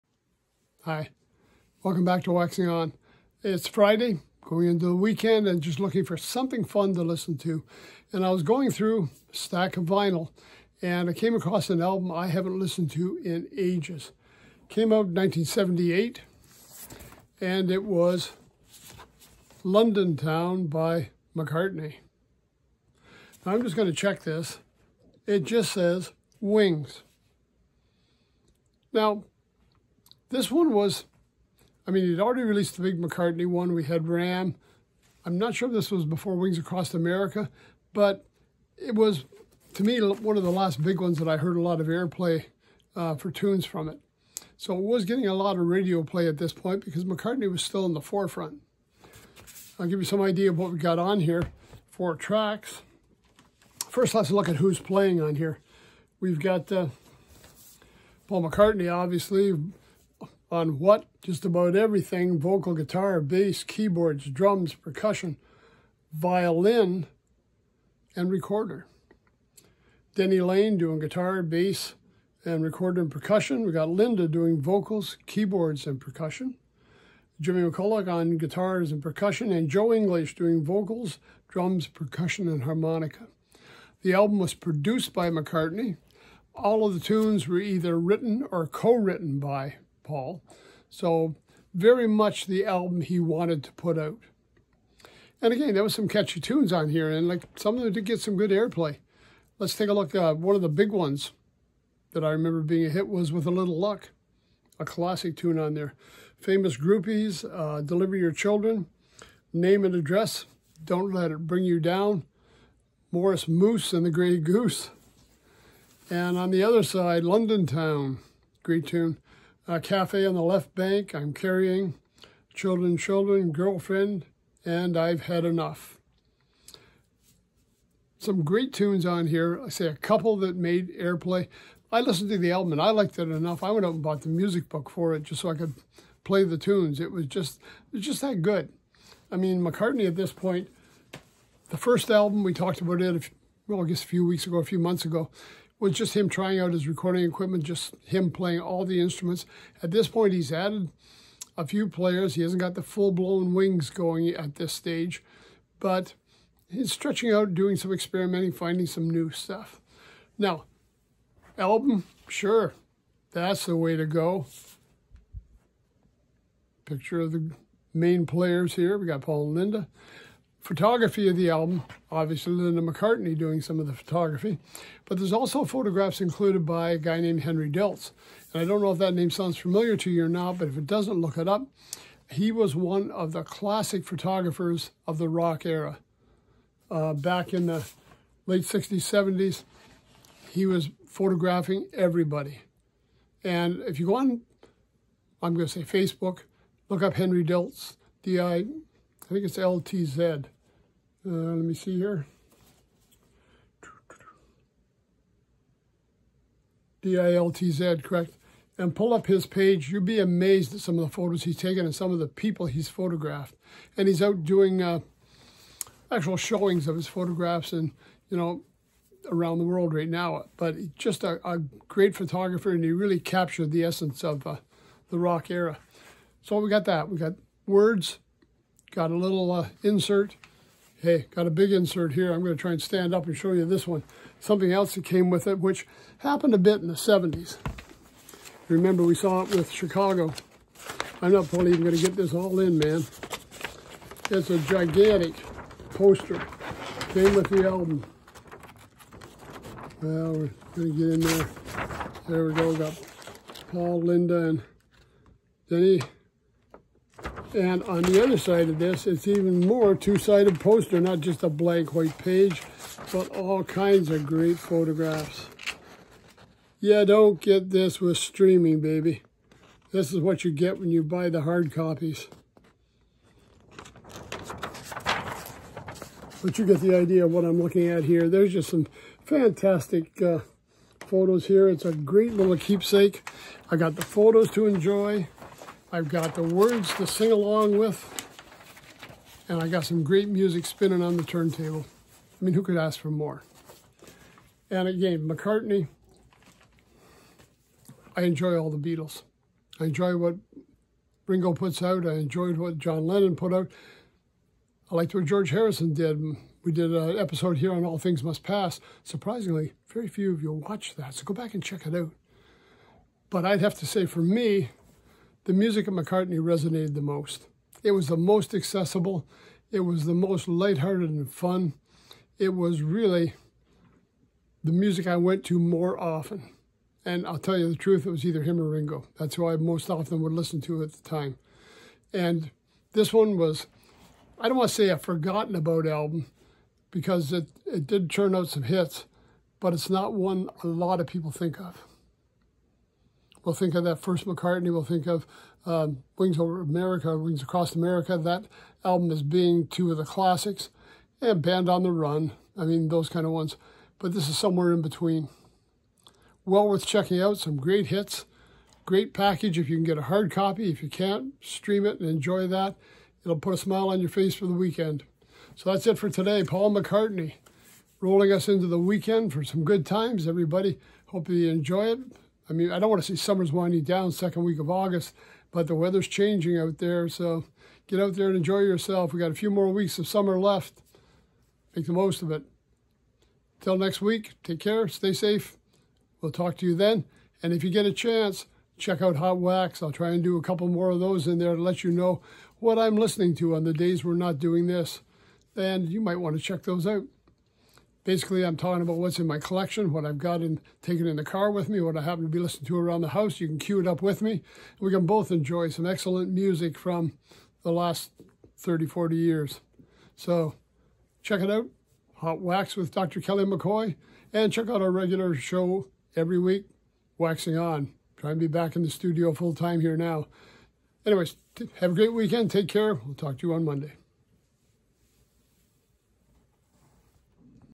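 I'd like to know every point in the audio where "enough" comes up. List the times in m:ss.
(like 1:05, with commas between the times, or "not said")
2:05, 2:13.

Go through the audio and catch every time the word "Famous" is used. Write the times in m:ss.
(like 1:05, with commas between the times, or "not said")
1:46.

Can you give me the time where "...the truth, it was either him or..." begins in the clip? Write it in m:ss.
5:27.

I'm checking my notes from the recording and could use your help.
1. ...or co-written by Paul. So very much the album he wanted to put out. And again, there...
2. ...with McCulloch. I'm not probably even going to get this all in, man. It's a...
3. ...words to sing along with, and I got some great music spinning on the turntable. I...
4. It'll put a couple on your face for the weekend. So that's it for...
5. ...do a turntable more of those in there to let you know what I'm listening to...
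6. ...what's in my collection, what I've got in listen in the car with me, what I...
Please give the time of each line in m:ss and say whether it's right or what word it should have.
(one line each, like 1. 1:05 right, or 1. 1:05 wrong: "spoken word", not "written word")
1. 1:28 right
2. 3:59 wrong: "Chicago", not "McCulloch"
3. 4:46 right
4. 6:03 wrong: "smile", not "couple"
5. 6:30 wrong: "couple", not "turntable"
6. 6:38 wrong: "taken", not "listen".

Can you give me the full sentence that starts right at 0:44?
So it was getting a lot of radio play at this point because McCartney was still in the forefront.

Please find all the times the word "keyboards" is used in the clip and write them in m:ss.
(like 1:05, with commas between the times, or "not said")
1:03, 1:15.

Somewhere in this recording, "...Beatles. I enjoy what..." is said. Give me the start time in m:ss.
4:58.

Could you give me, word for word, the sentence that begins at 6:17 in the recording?
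So get out there and enjoy yourself.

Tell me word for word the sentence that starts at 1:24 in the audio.
The album was produced by McCartney.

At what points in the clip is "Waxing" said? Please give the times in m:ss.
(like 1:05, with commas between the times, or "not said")
0:02, 6:57.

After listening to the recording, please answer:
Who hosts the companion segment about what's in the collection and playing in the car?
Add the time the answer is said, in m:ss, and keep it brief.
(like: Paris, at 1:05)
Dr. Kelly McCoy, at 6:52.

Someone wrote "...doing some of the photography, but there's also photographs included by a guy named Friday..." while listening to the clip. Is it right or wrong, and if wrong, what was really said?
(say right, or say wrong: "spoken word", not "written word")
wrong: "Henry", not "Friday".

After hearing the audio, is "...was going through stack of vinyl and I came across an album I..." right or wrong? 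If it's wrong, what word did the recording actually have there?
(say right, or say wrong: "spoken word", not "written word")
right.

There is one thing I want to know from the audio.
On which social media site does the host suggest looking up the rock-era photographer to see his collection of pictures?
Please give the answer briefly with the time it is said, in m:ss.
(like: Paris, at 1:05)
Facebook, at 3:15.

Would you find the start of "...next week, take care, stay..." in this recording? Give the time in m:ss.
6:23.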